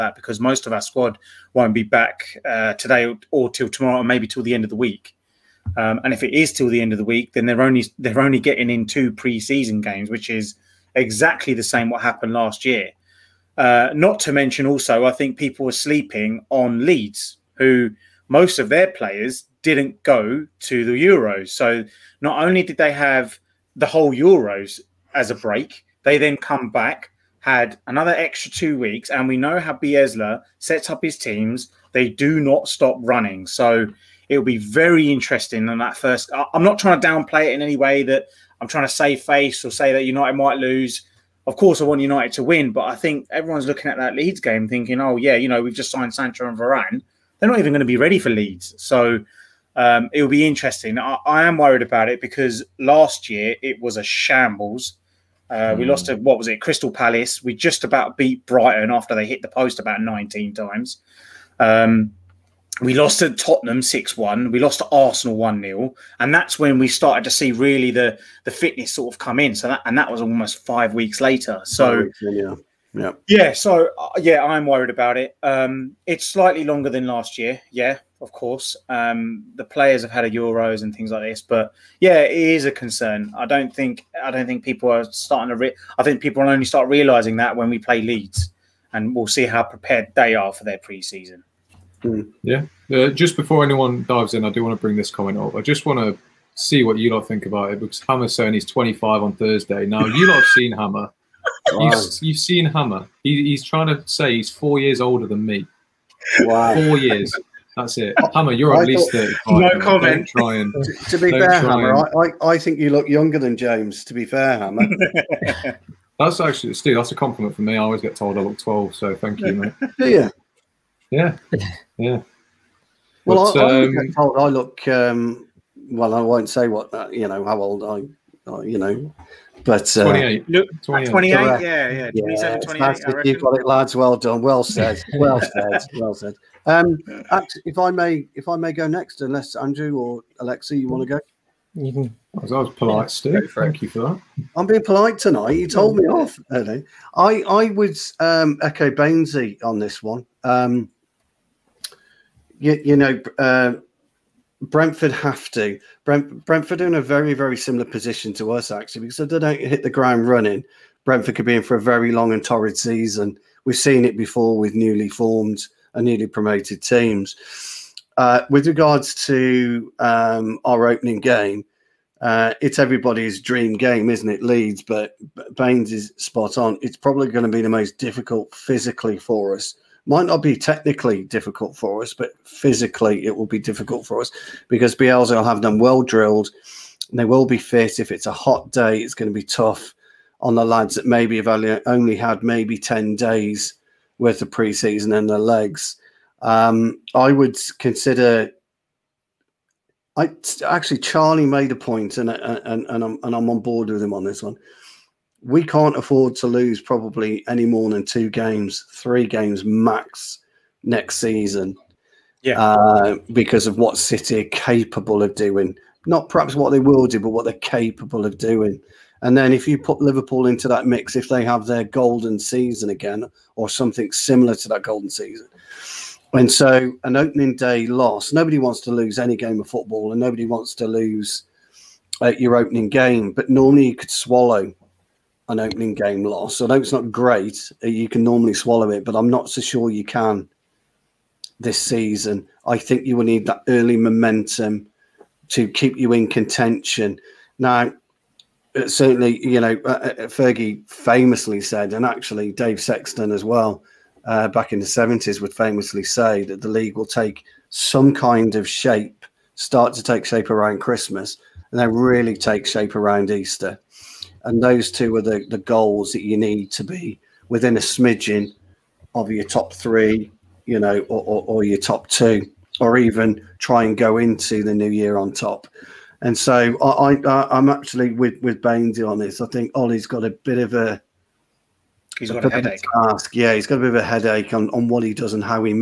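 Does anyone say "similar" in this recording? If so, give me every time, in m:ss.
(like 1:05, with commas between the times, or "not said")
2:37, 3:44.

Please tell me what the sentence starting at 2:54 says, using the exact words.
Leeds, but Baines is spot on.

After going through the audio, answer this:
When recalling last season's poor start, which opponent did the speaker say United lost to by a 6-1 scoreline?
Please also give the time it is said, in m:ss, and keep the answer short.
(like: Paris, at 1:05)
Tottenham, at 1:03.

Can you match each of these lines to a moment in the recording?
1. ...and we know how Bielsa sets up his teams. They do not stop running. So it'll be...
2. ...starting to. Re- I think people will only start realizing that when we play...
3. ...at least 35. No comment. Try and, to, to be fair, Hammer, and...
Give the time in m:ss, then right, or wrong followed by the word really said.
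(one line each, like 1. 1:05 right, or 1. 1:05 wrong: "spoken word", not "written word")
1. 0:29 right
2. 1:25 right
3. 1:48 right.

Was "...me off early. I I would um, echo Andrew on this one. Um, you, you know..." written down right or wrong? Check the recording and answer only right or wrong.
wrong.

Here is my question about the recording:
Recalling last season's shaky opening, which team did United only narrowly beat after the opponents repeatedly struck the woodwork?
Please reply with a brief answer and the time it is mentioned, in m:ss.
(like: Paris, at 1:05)
Brighton, at 0:58.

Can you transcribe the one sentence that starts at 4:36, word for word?
And so I, I am actually with with Bainesy on this.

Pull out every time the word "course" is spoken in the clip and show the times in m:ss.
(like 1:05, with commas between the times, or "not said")
0:41, 1:18.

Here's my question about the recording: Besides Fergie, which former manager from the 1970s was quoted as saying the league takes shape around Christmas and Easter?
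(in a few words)
Dave Sexton.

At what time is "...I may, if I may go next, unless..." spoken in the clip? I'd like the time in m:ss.
2:17.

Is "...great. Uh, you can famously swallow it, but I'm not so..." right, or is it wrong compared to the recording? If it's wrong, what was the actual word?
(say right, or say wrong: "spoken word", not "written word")
wrong: "normally", not "famously".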